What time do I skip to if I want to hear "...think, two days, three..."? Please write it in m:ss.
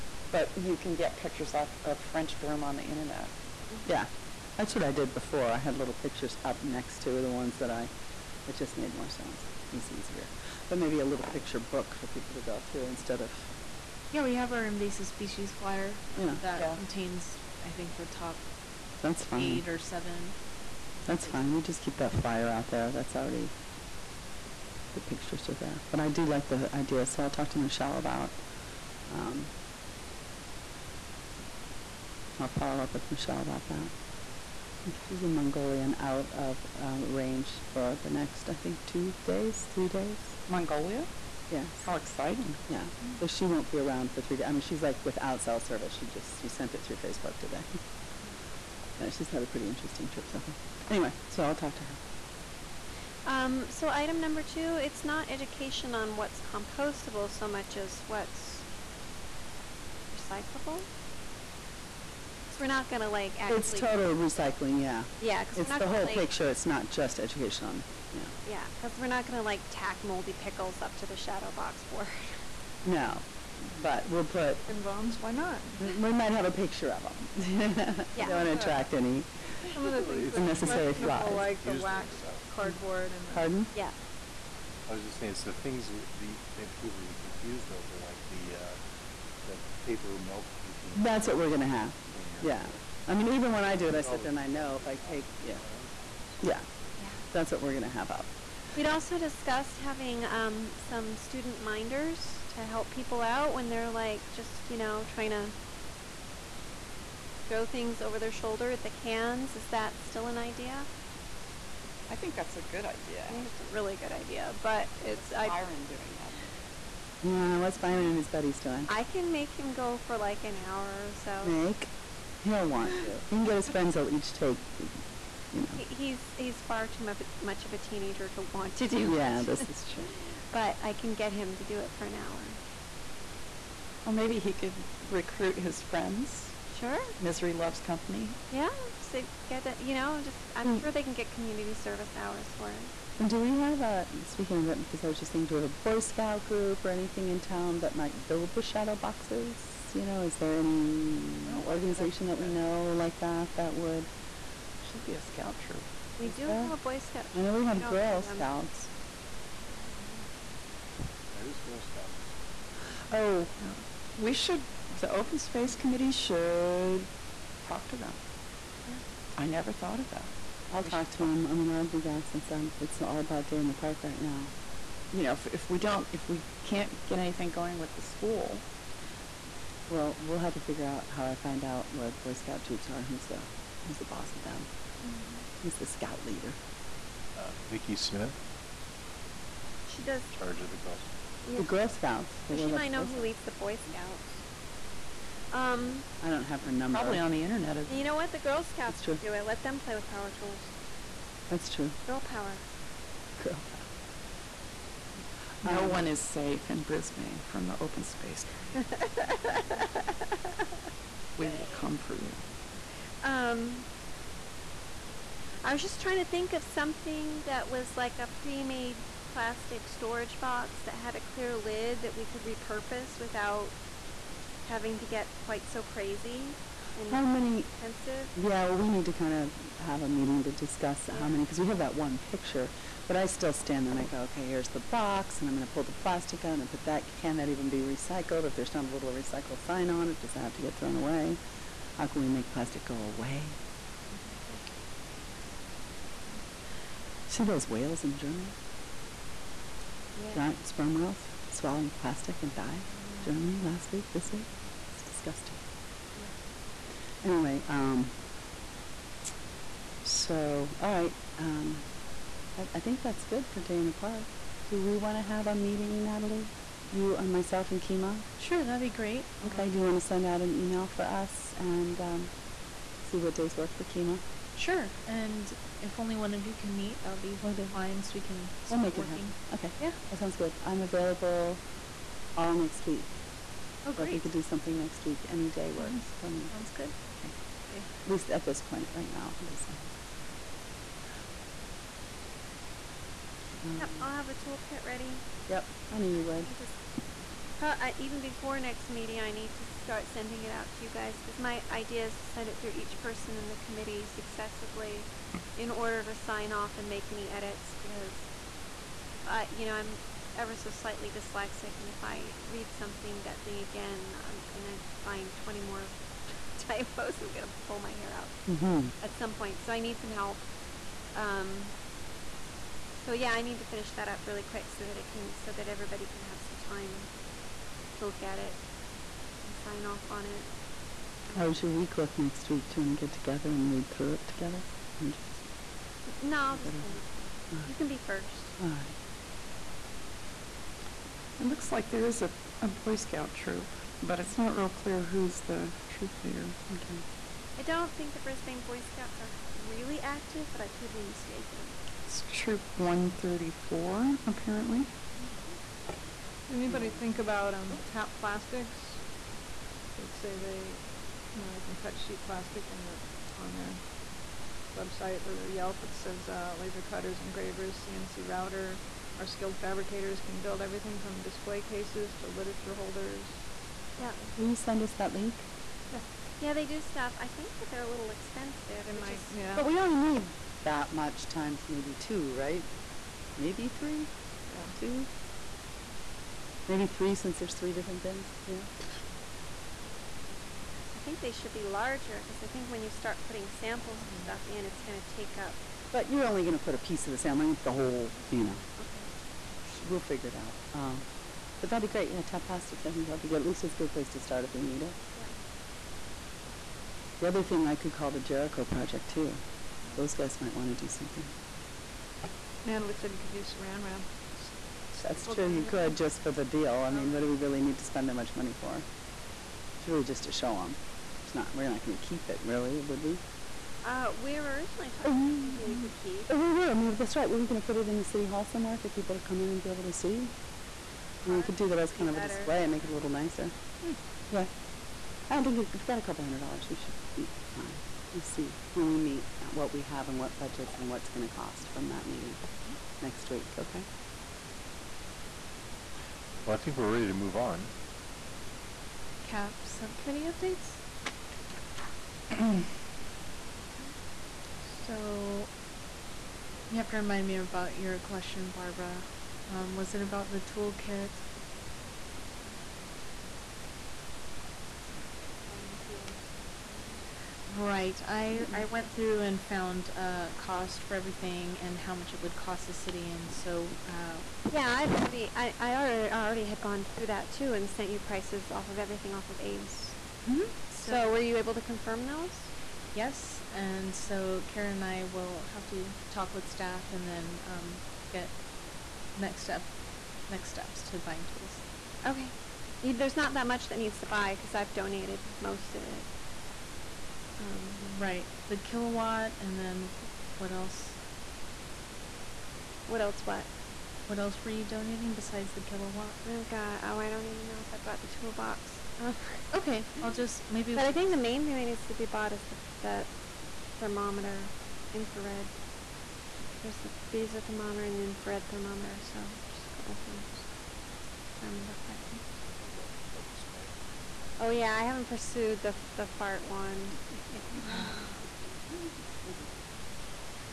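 0:38.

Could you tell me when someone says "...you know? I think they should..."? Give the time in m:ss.
6:28.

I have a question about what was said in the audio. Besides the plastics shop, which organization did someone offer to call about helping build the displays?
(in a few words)
Jericho Project.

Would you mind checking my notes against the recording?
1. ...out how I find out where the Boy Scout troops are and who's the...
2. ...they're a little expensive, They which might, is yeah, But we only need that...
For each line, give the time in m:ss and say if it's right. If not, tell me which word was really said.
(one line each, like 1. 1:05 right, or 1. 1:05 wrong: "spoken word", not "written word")
1. 3:00 right
2. 6:17 right.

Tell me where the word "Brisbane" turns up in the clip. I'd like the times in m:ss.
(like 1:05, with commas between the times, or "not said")
3:26, 5:48.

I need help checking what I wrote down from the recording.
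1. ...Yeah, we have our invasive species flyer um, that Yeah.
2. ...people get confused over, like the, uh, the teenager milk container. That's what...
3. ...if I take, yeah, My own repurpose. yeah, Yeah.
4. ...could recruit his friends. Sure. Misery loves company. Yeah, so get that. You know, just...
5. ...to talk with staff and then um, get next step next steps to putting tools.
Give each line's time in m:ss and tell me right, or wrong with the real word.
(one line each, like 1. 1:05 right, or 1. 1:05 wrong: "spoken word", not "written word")
1. 0:14 right
2. 1:26 wrong: "paper", not "teenager"
3. 1:34 wrong: "house", not "repurpose"
4. 2:14 right
5. 8:05 wrong: "buying", not "putting".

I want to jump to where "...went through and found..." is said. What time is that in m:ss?
7:48.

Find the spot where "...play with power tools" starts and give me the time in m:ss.
3:19.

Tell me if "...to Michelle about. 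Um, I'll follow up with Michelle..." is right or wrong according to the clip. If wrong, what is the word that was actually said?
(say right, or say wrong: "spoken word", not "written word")
right.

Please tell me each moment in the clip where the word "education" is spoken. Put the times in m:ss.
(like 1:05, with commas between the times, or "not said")
0:55, 1:07.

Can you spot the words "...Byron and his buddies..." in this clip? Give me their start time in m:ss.
1:57.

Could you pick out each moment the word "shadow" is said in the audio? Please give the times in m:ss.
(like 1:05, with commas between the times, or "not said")
1:11, 2:28.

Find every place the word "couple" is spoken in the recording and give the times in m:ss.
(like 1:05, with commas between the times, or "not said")
7:16, 8:39.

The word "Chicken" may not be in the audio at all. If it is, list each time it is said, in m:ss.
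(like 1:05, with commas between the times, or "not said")
1:14.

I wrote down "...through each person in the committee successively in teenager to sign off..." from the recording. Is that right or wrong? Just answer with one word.
wrong.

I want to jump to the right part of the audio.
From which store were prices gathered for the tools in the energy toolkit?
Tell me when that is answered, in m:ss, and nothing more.
7:59.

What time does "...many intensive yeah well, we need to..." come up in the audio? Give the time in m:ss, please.
3:47.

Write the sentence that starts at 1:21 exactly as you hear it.
Like the waxed cardboard and the, pardon?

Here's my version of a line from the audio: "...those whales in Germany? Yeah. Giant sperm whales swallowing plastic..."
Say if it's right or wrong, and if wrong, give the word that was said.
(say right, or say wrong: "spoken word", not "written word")
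right.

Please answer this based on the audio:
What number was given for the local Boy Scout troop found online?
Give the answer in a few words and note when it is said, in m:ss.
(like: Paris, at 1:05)
134, at 5:52.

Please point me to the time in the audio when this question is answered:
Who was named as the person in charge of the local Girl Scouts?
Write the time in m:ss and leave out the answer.
3:07.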